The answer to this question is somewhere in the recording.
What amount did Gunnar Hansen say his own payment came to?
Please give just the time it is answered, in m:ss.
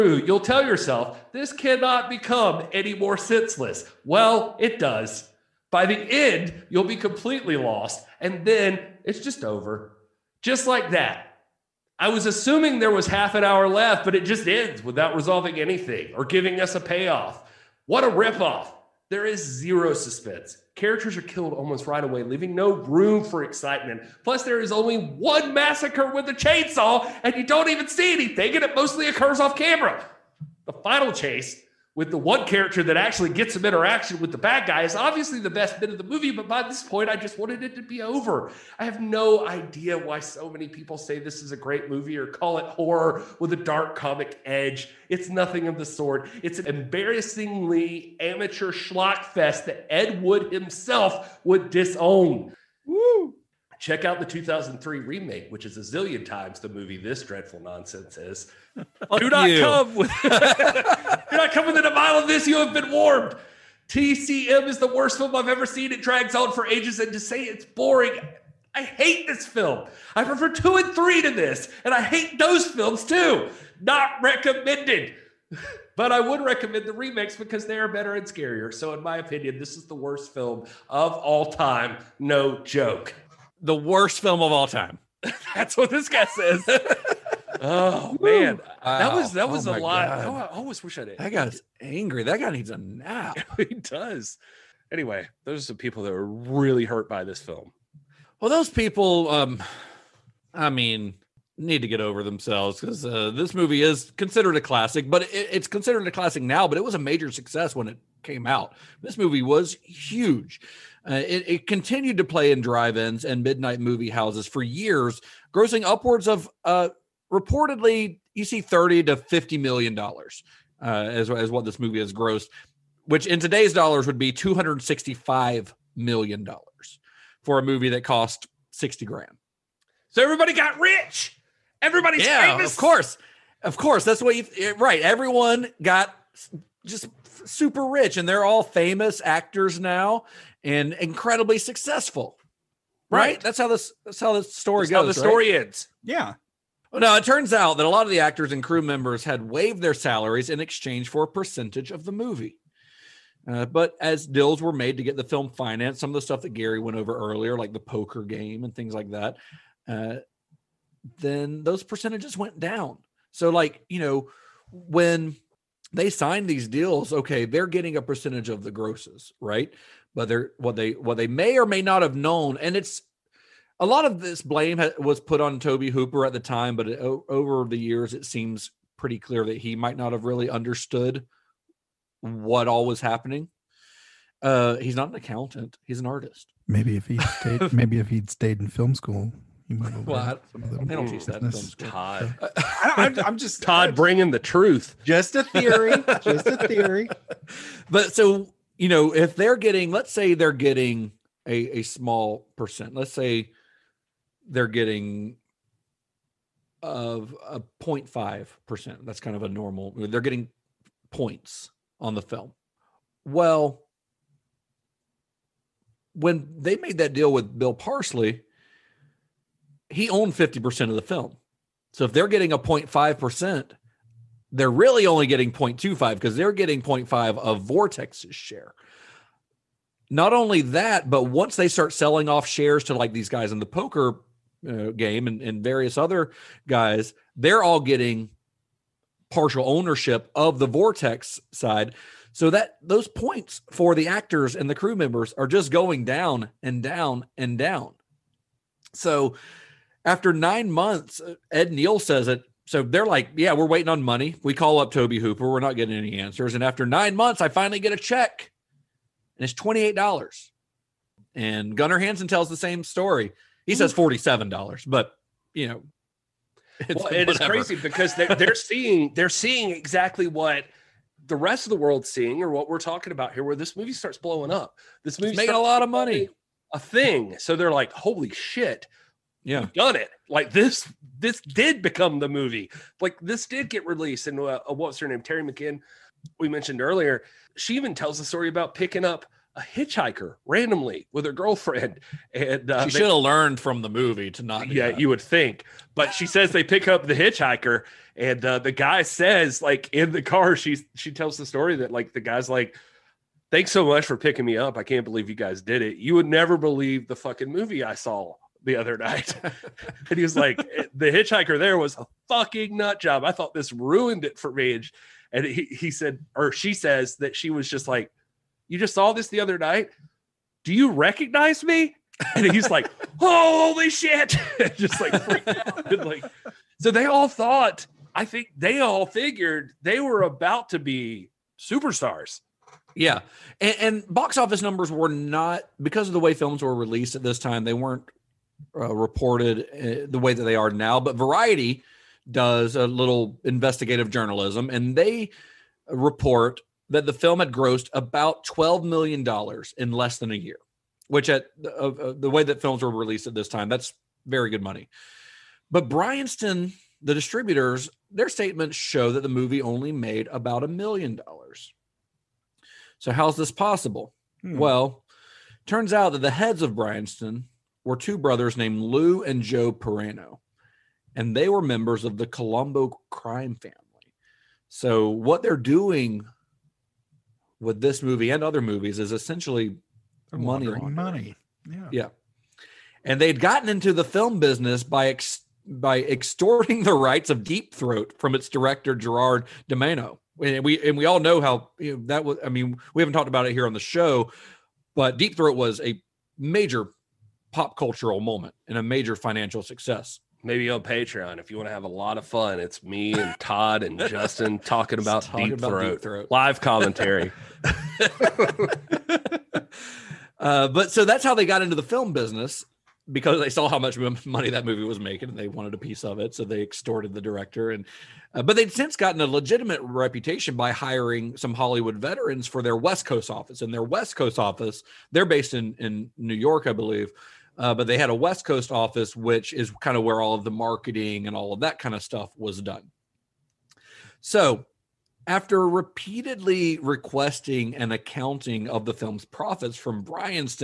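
4:23.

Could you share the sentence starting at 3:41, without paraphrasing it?
So if they're getting a 0.5%, they're really only getting 0.25 because they're getting 0.5 of Vortex's share.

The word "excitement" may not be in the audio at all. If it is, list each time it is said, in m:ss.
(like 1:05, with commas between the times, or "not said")
0:23.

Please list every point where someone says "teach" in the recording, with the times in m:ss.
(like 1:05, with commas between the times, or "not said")
3:11.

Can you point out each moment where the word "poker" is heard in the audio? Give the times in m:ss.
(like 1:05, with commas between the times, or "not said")
2:37, 3:53.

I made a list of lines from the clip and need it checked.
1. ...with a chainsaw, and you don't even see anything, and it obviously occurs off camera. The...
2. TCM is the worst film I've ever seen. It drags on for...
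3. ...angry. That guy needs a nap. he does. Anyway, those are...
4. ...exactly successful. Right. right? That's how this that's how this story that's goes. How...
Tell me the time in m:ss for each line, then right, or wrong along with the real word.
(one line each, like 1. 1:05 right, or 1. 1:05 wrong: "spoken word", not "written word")
1. 0:26 wrong: "mostly", not "obviously"
2. 1:03 right
3. 1:31 right
4. 2:20 wrong: "incredibly", not "exactly".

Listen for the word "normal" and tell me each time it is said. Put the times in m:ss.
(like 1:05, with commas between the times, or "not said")
3:29.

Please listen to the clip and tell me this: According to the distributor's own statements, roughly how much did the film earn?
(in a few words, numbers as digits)
about a million dollars.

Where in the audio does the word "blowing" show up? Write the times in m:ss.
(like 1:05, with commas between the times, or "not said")
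4:34.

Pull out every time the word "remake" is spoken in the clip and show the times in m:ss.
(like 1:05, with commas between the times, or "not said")
0:54, 1:16.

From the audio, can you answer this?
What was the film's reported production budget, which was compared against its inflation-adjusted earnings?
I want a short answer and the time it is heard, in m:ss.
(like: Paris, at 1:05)
60 grand, at 2:08.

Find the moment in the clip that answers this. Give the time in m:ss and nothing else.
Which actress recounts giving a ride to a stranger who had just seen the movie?
4:45.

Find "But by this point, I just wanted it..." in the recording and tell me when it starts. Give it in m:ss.
0:36.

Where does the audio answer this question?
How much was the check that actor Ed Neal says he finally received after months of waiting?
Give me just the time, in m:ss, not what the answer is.
4:19.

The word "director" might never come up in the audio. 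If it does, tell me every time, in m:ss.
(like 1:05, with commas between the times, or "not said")
6:28, 6:57.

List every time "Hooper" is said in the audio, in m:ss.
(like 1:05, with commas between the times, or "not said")
2:55, 4:15.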